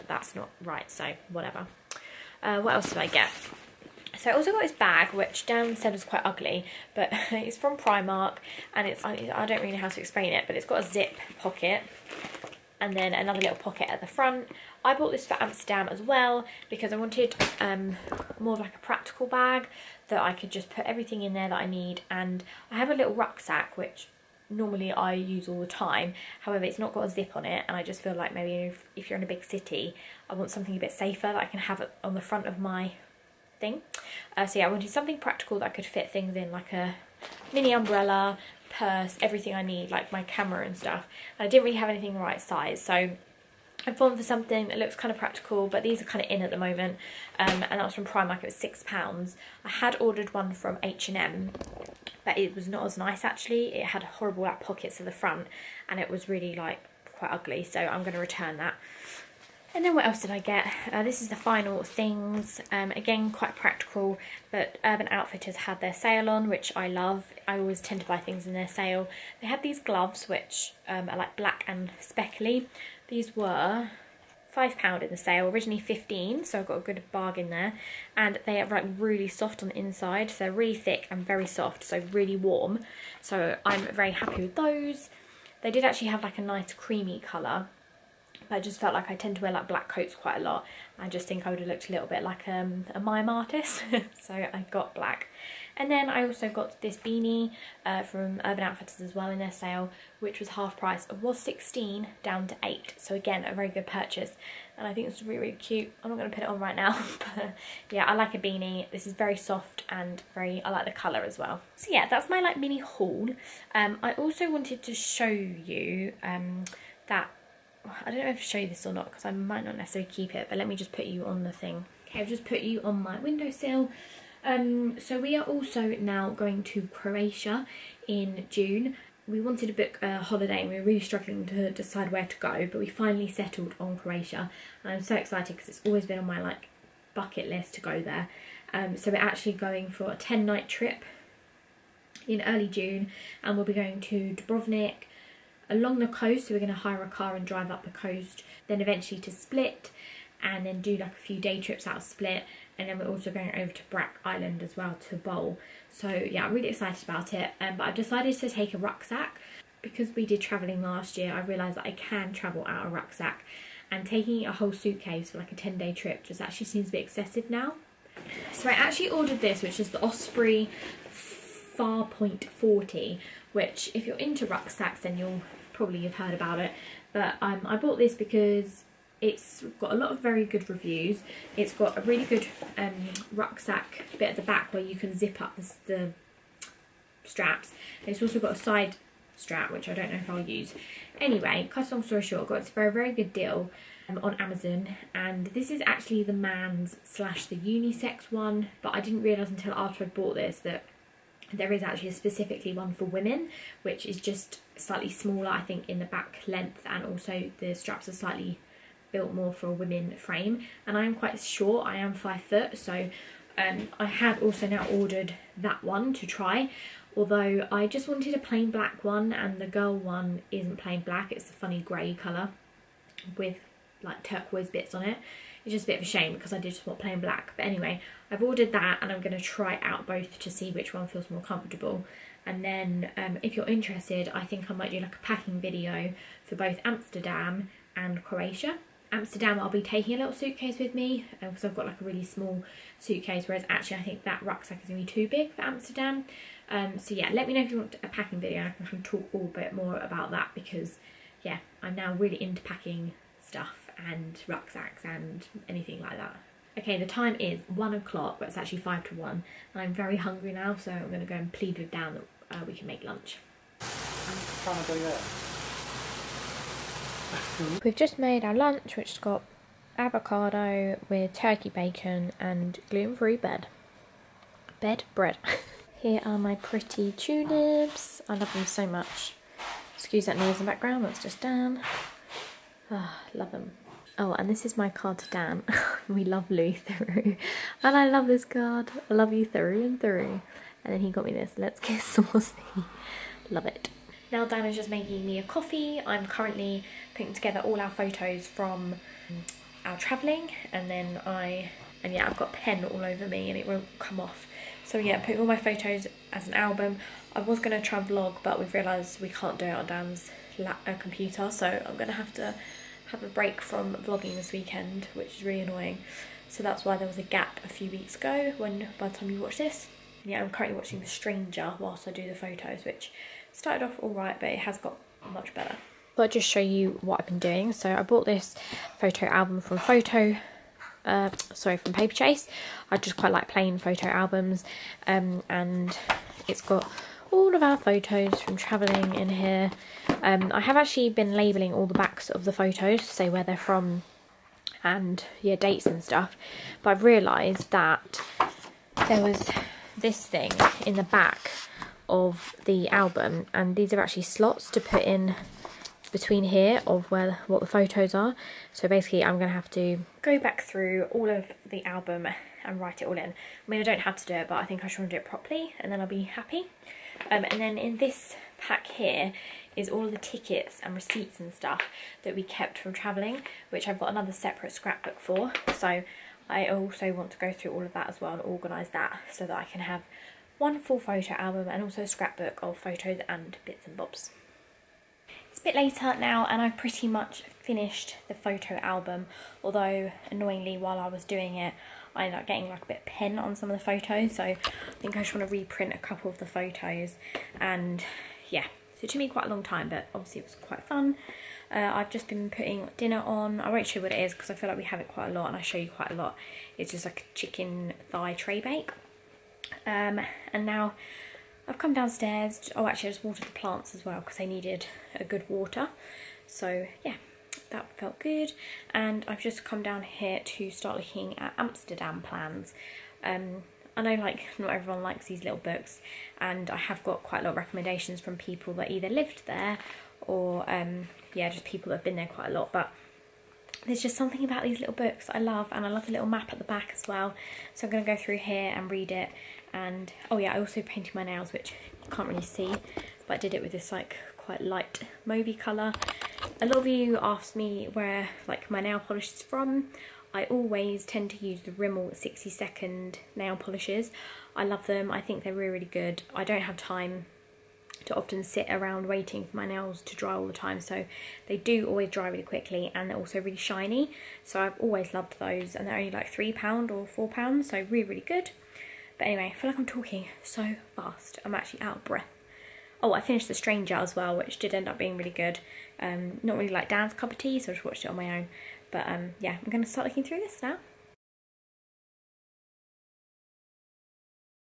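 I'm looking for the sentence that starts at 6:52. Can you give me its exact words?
Oh, actually, I just watered the plants as well because they needed a good water.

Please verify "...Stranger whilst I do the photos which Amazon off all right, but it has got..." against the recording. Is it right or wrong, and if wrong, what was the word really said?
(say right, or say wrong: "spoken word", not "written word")
wrong: "Started", not "Amazon".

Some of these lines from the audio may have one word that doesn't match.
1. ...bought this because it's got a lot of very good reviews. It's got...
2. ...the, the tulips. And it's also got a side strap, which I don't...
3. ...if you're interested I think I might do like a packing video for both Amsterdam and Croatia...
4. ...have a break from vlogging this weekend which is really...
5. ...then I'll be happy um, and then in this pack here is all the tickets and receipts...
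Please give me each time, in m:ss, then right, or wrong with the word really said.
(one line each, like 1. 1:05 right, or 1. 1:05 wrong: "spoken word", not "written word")
1. 2:57 right
2. 3:05 wrong: "straps", not "tulips"
3. 3:53 right
4. 5:13 right
5. 6:05 right.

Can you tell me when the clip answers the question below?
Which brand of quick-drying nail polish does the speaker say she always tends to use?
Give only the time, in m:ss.
7:31.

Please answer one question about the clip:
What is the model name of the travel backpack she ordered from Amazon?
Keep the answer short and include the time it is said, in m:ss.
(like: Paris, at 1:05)
Osprey Farpoint 40, at 2:50.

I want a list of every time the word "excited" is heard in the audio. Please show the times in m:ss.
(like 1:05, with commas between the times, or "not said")
2:15, 2:36.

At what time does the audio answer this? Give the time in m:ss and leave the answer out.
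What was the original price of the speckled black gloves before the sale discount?
1:15.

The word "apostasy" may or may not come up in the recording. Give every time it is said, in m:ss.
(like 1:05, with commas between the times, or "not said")
not said.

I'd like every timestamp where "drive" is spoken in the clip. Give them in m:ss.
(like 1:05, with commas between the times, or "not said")
2:27.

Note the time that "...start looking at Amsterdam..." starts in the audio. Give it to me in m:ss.
7:00.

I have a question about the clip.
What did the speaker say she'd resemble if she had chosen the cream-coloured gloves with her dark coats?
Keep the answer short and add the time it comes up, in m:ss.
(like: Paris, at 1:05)
A mime artist, at 1:32.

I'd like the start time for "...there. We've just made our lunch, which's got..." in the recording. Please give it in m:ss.
4:24.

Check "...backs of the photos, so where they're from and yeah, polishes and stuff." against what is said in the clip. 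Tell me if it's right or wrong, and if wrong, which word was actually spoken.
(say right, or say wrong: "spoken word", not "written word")
wrong: "dates", not "polishes".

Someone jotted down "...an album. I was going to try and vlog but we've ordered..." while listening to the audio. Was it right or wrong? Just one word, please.
wrong.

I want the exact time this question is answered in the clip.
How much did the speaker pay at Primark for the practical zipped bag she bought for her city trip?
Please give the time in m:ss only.
0:48.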